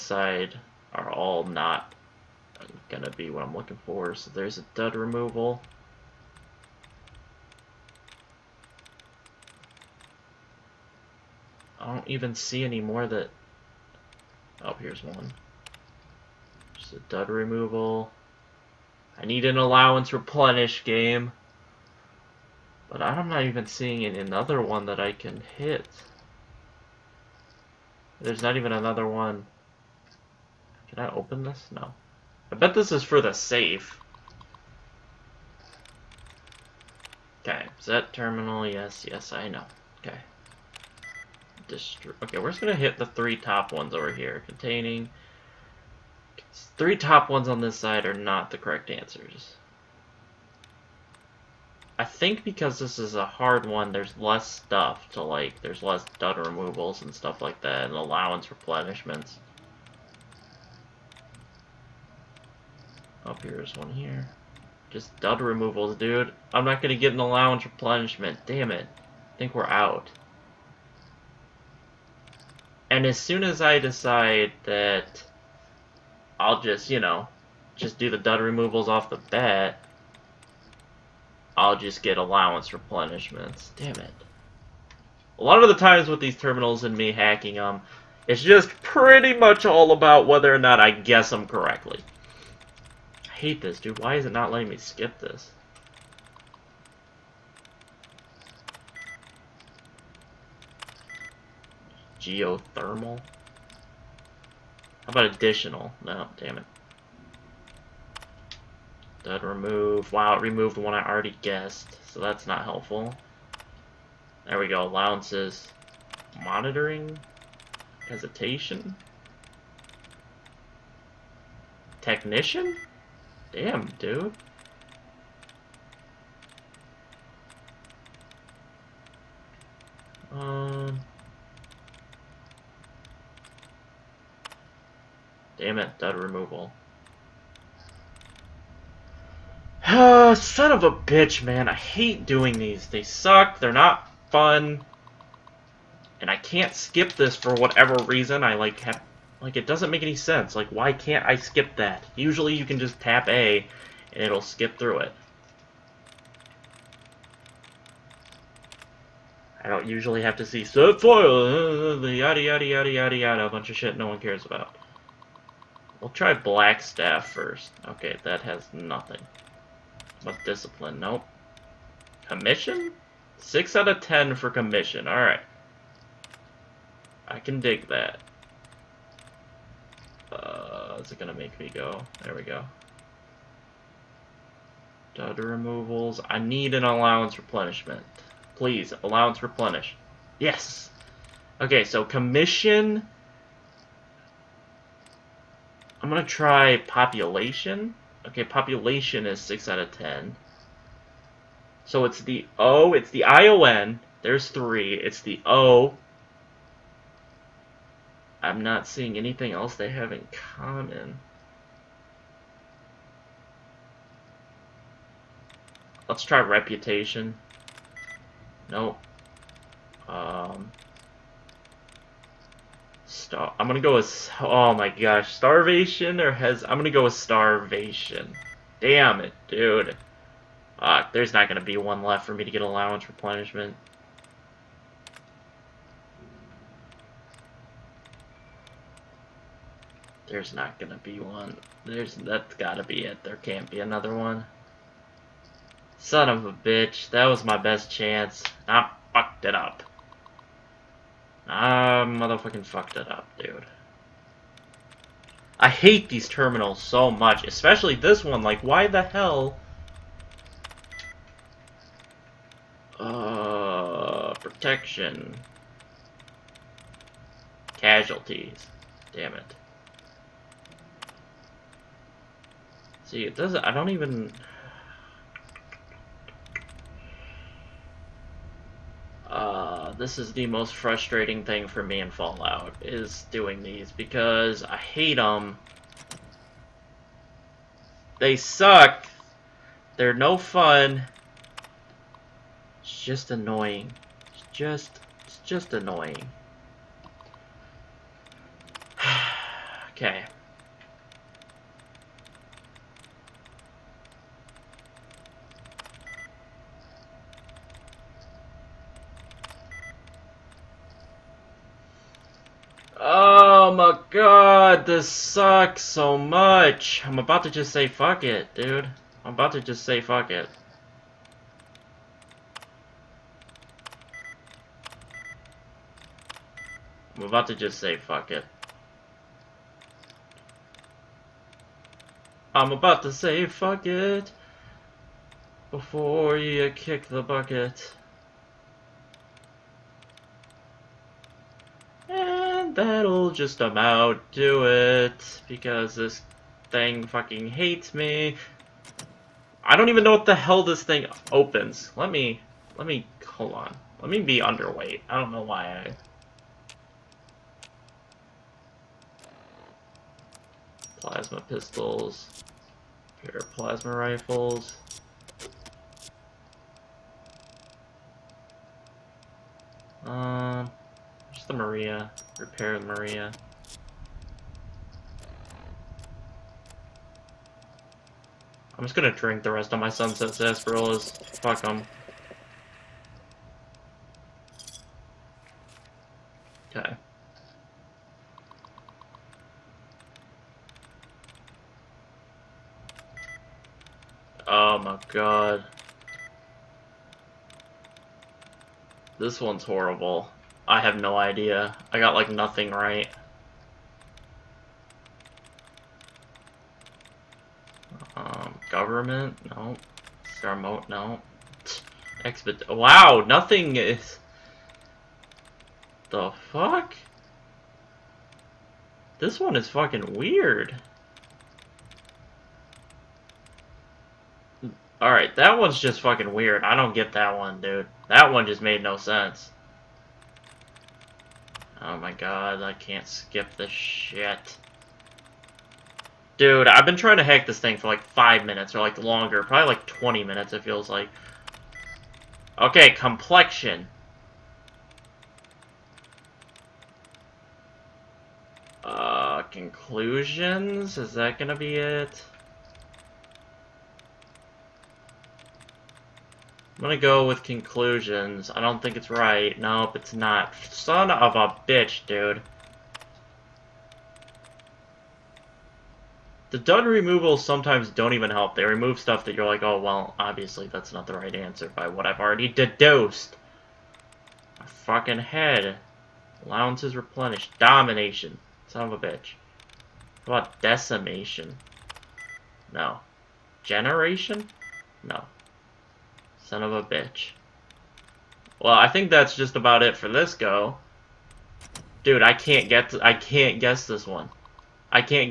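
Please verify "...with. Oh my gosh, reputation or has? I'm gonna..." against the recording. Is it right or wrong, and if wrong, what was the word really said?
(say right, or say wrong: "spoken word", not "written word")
wrong: "starvation", not "reputation".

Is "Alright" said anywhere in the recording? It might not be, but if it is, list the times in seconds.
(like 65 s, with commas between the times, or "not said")
175 s, 425 s.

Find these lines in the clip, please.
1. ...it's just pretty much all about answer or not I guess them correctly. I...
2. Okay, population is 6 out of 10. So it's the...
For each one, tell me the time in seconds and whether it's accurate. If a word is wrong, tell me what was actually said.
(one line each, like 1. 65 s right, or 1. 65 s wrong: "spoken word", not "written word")
1. 88 s wrong: "whether", not "answer"
2. 198 s right.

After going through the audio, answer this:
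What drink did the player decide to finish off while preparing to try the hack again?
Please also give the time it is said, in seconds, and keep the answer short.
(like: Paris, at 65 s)
sunset sarsaparillas, at 379 s.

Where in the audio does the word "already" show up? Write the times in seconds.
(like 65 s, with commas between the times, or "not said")
111 s, 472 s.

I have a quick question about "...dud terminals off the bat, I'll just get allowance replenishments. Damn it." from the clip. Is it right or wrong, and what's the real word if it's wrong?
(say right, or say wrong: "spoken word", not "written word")
wrong: "removals", not "terminals".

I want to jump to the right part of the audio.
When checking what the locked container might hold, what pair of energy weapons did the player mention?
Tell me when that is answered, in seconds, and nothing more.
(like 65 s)
363 s.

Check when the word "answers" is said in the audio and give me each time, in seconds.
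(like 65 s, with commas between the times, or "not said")
48 s, 471 s.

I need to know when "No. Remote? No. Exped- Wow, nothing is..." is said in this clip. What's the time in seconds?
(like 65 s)
409 s.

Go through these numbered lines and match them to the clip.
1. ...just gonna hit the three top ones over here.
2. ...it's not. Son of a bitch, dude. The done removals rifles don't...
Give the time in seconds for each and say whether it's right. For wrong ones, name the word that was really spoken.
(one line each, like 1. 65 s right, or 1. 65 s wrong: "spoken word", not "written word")
1. 42 s right
2. 459 s wrong: "sometimes", not "rifles".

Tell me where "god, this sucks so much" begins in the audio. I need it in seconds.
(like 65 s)
314 s.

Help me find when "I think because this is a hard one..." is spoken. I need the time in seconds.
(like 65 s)
51 s.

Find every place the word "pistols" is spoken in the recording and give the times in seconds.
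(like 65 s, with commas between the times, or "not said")
361 s.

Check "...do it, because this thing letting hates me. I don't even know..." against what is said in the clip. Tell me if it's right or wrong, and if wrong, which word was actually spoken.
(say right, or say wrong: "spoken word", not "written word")
wrong: "fucking", not "letting".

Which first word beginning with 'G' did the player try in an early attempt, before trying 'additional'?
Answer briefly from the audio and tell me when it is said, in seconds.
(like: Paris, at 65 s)
Geothermal, at 102 s.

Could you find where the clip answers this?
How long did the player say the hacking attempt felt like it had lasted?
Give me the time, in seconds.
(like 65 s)
439 s.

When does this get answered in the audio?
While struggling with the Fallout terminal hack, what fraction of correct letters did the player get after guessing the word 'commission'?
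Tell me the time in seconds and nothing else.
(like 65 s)
173 s.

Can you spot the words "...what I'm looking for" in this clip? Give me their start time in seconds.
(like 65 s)
3 s.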